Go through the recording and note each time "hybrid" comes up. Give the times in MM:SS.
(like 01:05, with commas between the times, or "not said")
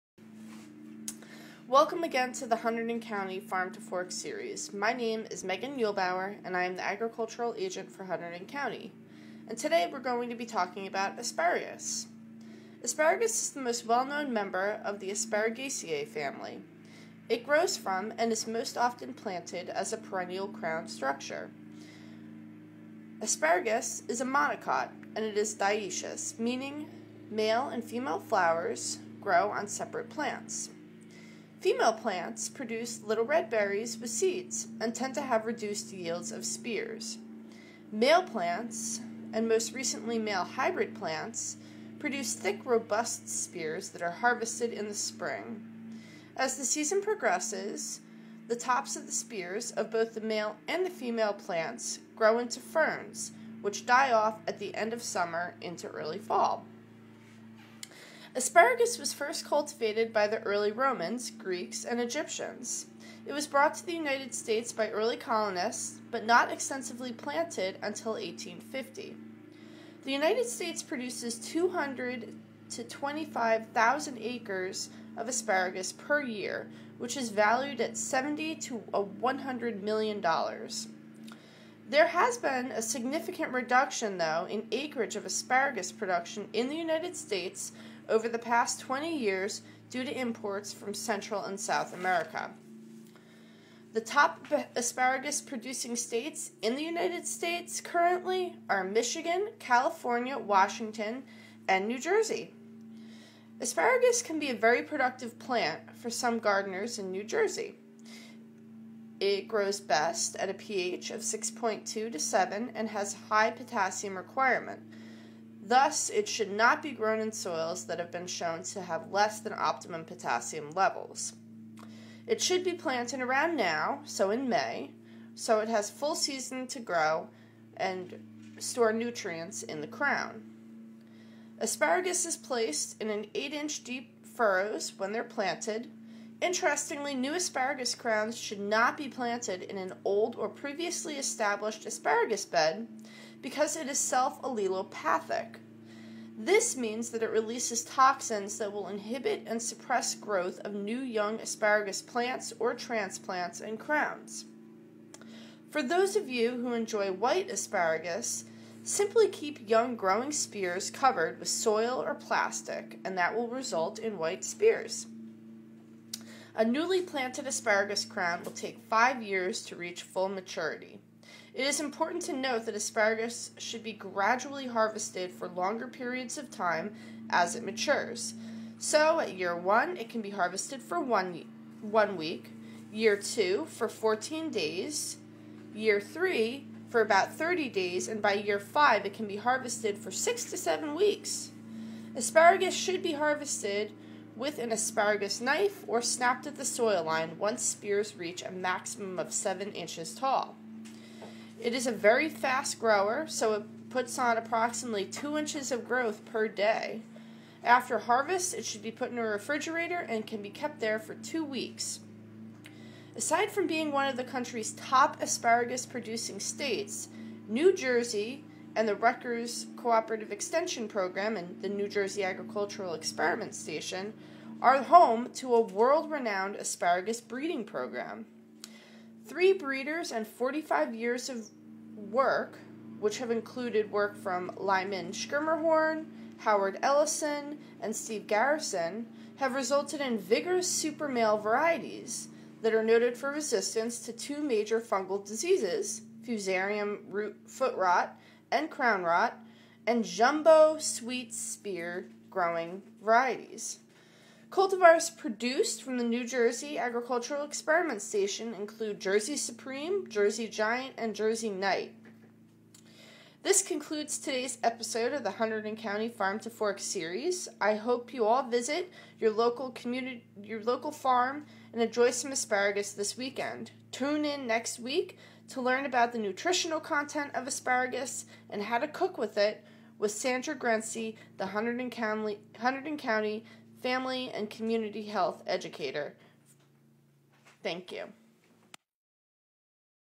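00:40.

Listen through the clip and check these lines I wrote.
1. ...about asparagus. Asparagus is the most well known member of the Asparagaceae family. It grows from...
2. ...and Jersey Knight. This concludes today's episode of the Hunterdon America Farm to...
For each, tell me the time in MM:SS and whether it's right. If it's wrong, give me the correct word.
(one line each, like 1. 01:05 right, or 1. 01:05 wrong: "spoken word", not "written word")
1. 00:10 right
2. 04:20 wrong: "County", not "America".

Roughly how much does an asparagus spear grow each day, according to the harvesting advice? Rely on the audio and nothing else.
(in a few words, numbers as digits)
2 inches.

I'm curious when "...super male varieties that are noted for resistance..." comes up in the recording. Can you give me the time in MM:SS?
04:00.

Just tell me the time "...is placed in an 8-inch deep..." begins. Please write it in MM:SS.
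02:12.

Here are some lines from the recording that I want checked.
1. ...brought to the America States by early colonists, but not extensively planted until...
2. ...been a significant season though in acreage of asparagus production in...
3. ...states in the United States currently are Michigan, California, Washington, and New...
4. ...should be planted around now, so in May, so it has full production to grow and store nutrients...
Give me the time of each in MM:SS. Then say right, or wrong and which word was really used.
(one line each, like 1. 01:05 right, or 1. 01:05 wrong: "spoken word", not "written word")
1. 01:03 wrong: "United", not "America"
2. 01:22 wrong: "reduction", not "season"
3. 01:35 right
4. 02:02 wrong: "season", not "production".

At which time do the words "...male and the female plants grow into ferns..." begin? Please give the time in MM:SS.
00:50.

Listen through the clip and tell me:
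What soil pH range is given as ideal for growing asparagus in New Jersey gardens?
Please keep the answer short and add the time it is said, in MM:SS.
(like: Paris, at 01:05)
6.2 to 7, at 01:51.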